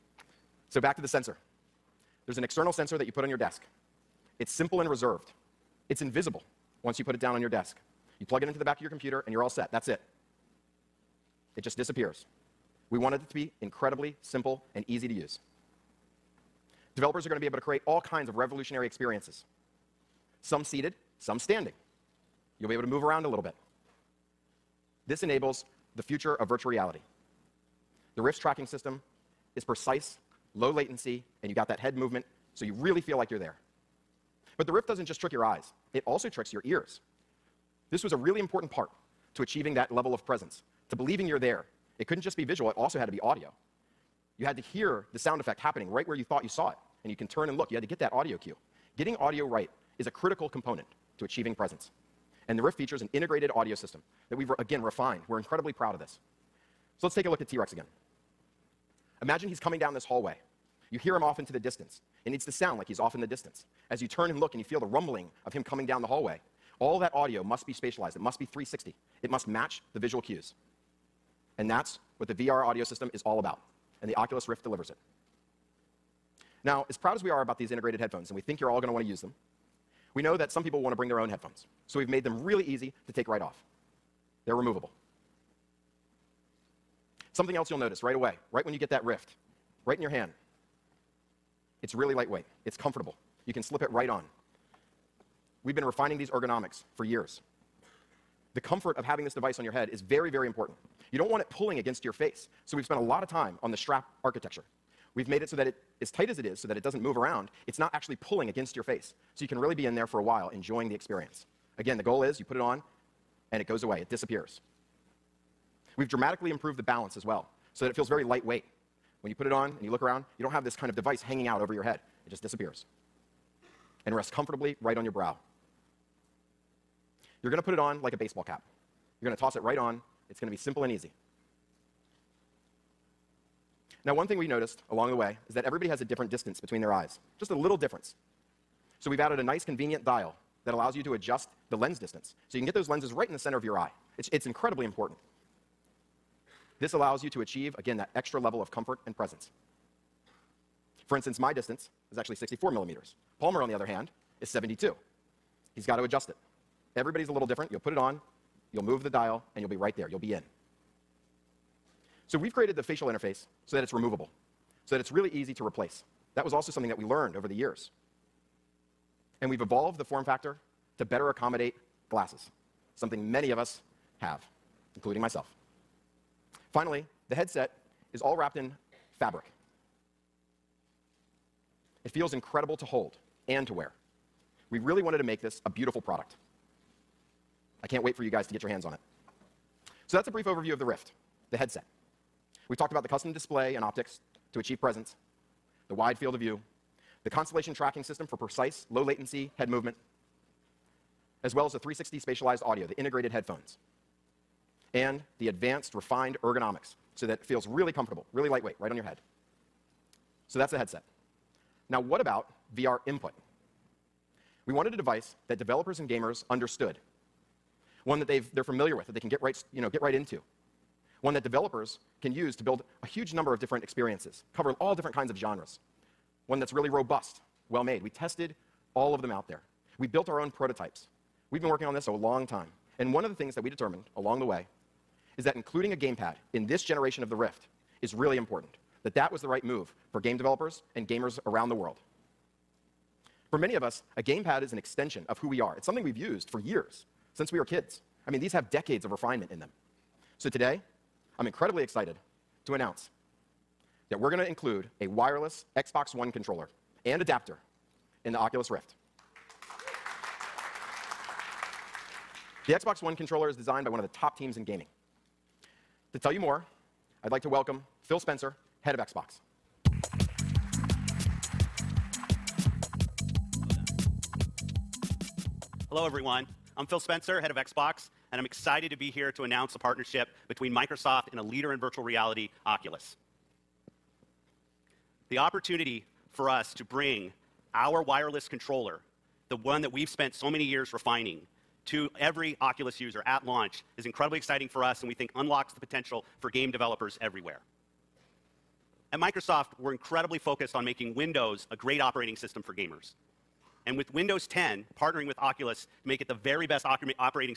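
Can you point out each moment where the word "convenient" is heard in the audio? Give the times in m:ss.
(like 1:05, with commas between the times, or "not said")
2:19.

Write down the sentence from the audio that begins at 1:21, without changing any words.
So we've made them really easy to take right off.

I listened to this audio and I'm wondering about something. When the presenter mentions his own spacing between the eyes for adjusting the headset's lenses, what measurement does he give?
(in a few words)
64 millimeters.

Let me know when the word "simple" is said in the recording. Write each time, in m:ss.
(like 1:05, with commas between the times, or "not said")
0:04, 0:14, 2:10.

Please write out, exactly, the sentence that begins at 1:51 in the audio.
Again, the goal is you put it on, and it goes away, it disappears.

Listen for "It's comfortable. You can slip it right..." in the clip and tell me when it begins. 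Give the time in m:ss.
1:32.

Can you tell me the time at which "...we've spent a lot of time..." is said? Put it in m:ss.
1:42.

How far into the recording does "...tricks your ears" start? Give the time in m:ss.
0:36.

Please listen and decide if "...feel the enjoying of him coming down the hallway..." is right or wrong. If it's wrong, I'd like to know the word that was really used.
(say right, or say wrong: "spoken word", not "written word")
wrong: "rumbling", not "enjoying".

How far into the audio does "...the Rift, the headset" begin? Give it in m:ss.
3:10.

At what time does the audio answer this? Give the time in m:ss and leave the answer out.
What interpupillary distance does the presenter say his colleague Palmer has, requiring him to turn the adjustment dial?
2:34.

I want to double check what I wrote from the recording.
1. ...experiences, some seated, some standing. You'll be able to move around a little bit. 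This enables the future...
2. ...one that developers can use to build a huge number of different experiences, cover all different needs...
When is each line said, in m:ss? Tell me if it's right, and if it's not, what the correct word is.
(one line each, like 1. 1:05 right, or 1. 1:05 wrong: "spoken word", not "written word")
1. 0:18 right
2. 3:41 wrong: "kinds", not "needs".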